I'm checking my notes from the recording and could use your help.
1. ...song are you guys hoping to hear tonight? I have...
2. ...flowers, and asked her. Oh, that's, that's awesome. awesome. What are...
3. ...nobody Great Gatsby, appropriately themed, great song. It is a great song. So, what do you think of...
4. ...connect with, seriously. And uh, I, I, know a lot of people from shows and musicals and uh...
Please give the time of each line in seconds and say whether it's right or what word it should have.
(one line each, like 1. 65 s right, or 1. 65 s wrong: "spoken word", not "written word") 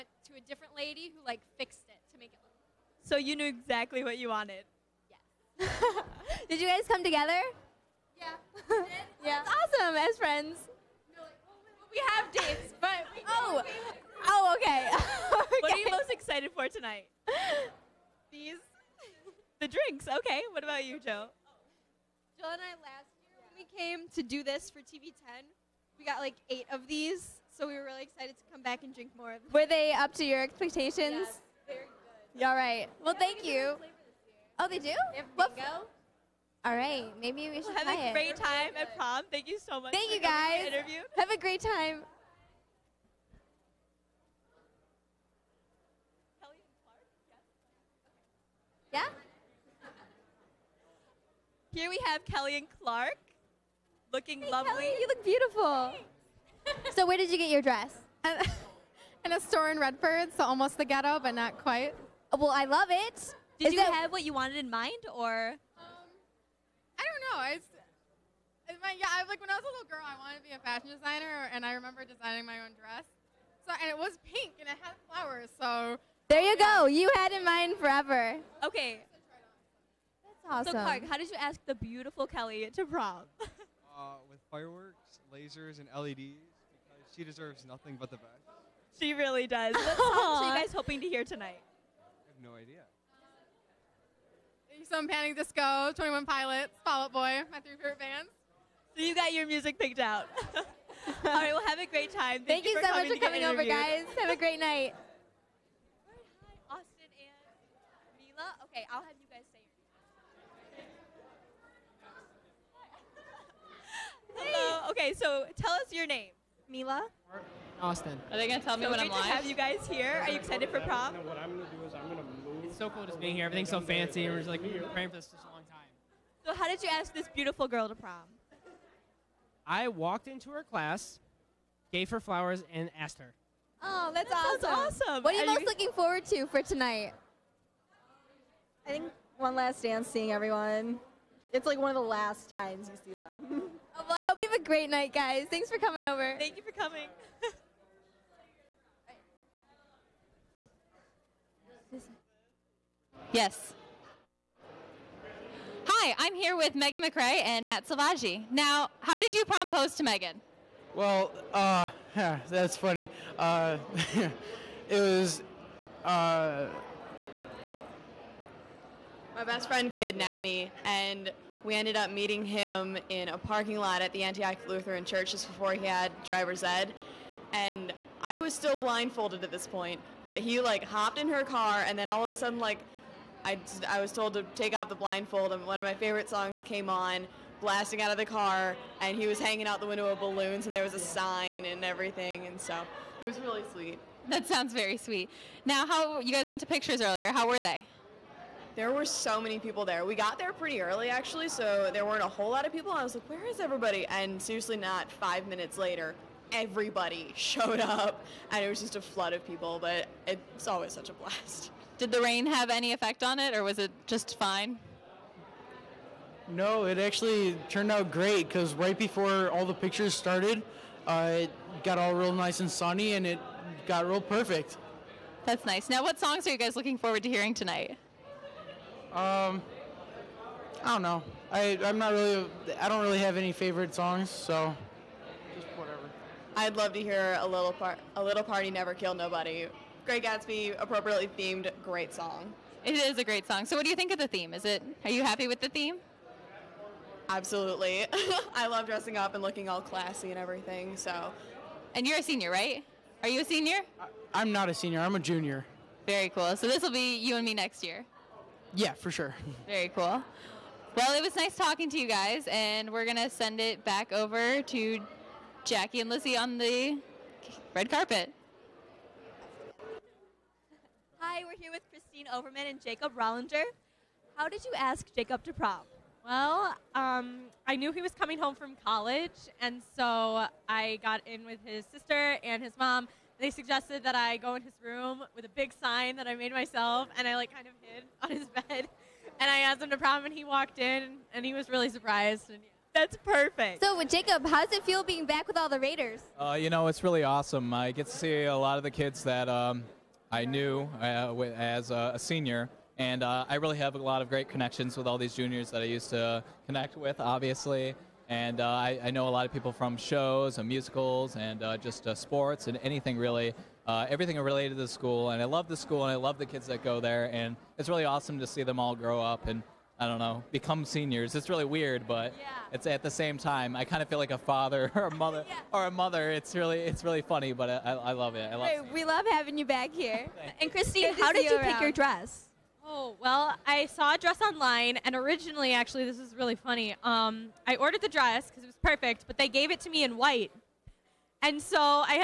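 1. 89 s right
2. 132 s right
3. 239 s right
4. 306 s wrong: "obviously", not "seriously".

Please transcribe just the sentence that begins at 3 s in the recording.
So you knew exactly what you wanted.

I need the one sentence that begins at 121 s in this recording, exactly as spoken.
No, what I'm going to do is I'm going to it's so cool just being here.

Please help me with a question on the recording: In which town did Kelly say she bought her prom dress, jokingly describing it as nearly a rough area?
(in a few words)
Redford.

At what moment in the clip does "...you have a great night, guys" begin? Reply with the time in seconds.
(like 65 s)
144 s.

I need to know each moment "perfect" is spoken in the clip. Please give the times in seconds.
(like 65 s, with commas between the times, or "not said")
224 s, 293 s, 338 s.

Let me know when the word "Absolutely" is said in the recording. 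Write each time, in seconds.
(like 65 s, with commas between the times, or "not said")
247 s.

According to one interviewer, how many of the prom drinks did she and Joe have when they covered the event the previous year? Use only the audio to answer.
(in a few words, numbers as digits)
8.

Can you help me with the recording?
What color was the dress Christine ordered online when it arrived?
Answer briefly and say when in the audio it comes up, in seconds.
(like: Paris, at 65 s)
White, at 340 s.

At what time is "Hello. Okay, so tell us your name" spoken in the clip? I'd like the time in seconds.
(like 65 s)
114 s.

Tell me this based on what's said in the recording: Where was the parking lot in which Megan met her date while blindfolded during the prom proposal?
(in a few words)
Antioch Lutheran Church.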